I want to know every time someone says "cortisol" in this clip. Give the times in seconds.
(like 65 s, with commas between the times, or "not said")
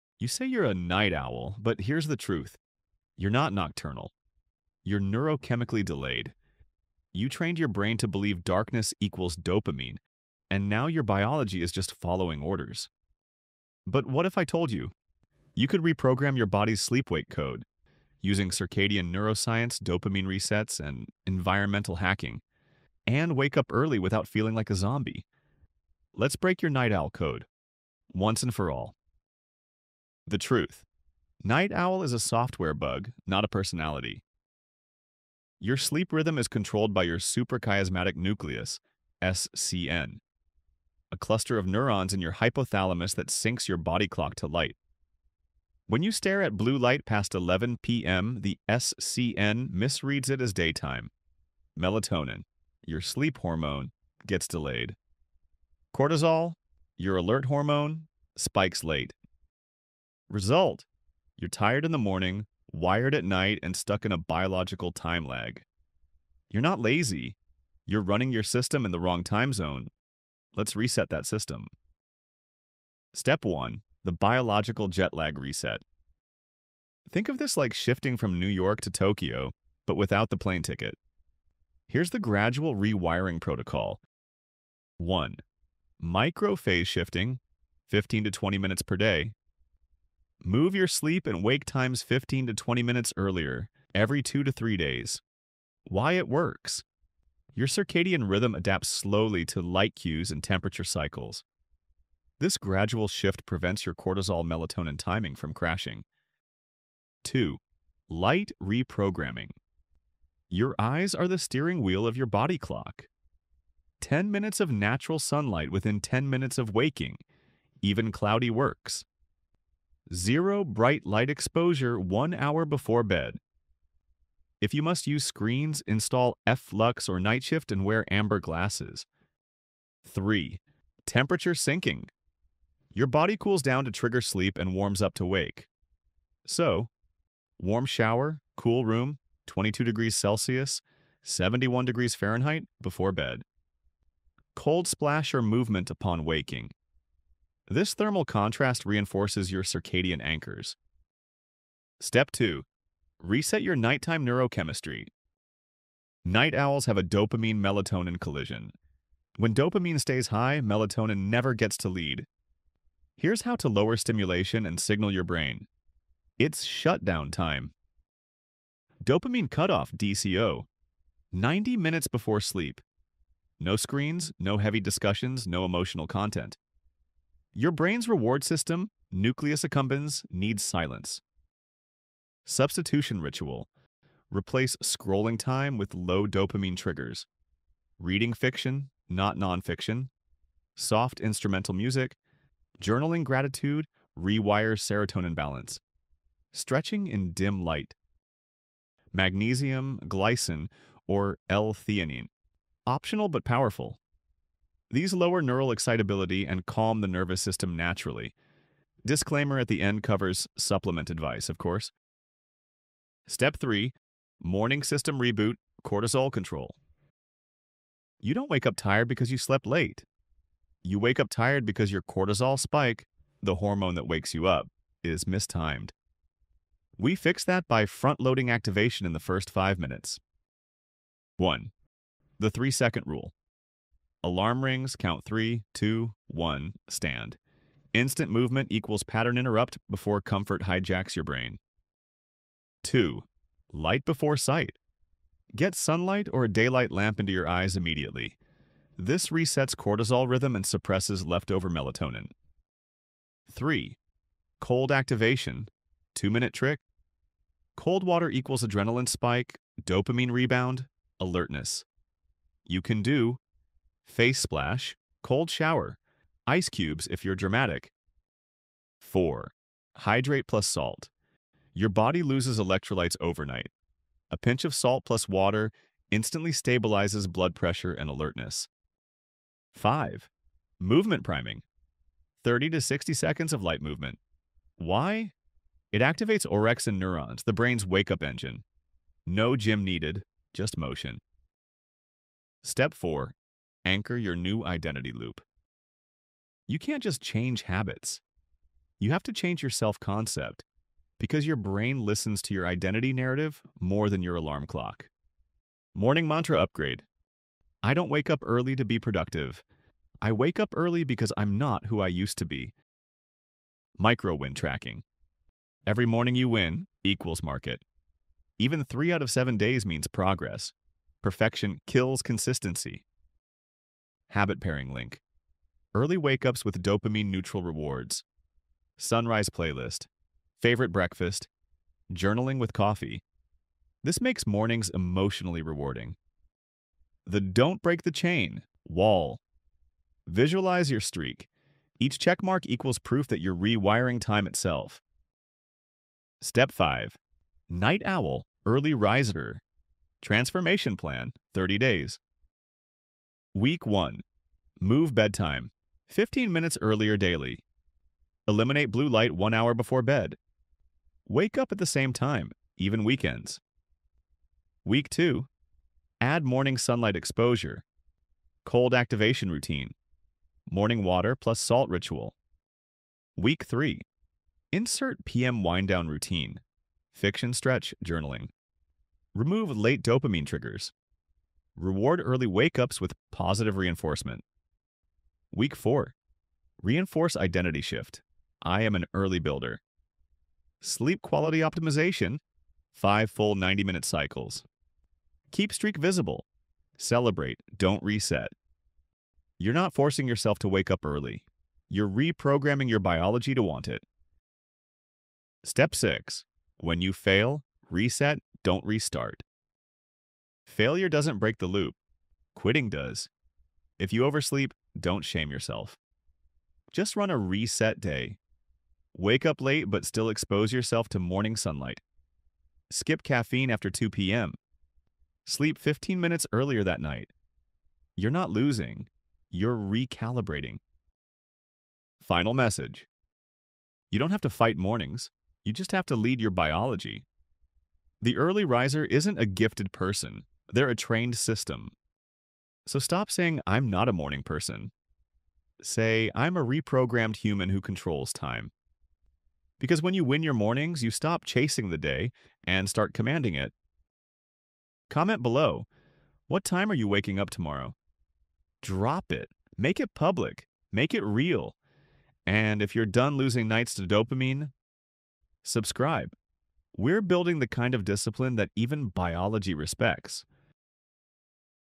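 55 s, 103 s, 215 s, 222 s, 249 s.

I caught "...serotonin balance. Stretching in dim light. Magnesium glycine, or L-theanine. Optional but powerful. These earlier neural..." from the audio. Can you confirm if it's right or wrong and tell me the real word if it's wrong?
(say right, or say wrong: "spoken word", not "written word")
wrong: "lower", not "earlier".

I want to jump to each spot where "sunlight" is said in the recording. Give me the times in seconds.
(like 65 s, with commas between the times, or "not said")
115 s, 245 s, 366 s, 421 s.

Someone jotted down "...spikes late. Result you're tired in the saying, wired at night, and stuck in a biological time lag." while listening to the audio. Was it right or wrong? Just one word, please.
wrong.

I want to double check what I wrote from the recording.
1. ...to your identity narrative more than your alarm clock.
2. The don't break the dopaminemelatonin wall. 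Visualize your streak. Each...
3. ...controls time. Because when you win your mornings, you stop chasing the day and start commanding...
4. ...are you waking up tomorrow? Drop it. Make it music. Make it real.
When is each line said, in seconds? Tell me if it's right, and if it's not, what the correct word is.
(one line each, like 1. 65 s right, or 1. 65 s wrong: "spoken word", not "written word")
1. 302 s right
2. 337 s wrong: "chain", not "dopaminemelatonin"
3. 447 s right
4. 456 s wrong: "public", not "music".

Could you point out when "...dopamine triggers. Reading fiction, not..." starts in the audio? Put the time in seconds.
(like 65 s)
186 s.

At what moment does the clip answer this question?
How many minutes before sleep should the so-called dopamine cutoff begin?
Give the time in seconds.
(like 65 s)
171 s.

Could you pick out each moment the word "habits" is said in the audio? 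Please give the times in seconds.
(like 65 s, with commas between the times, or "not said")
297 s, 324 s.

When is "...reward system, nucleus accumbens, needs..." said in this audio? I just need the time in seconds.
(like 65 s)
178 s.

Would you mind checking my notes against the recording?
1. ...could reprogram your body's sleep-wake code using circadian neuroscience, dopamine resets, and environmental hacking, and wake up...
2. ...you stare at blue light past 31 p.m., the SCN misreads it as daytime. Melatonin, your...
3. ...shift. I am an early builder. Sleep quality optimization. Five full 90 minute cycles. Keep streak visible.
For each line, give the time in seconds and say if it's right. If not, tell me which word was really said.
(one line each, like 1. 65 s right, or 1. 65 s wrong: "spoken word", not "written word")
1. 15 s right
2. 46 s wrong: "11", not "31"
3. 387 s right.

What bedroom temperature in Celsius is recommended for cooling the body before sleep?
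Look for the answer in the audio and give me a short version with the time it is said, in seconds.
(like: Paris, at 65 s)
22 degrees, at 139 s.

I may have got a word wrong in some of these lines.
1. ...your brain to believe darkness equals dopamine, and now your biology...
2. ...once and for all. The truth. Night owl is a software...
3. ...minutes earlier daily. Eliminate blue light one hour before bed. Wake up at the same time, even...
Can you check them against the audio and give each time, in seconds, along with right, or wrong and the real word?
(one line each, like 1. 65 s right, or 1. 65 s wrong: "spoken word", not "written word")
1. 7 s right
2. 28 s right
3. 356 s right.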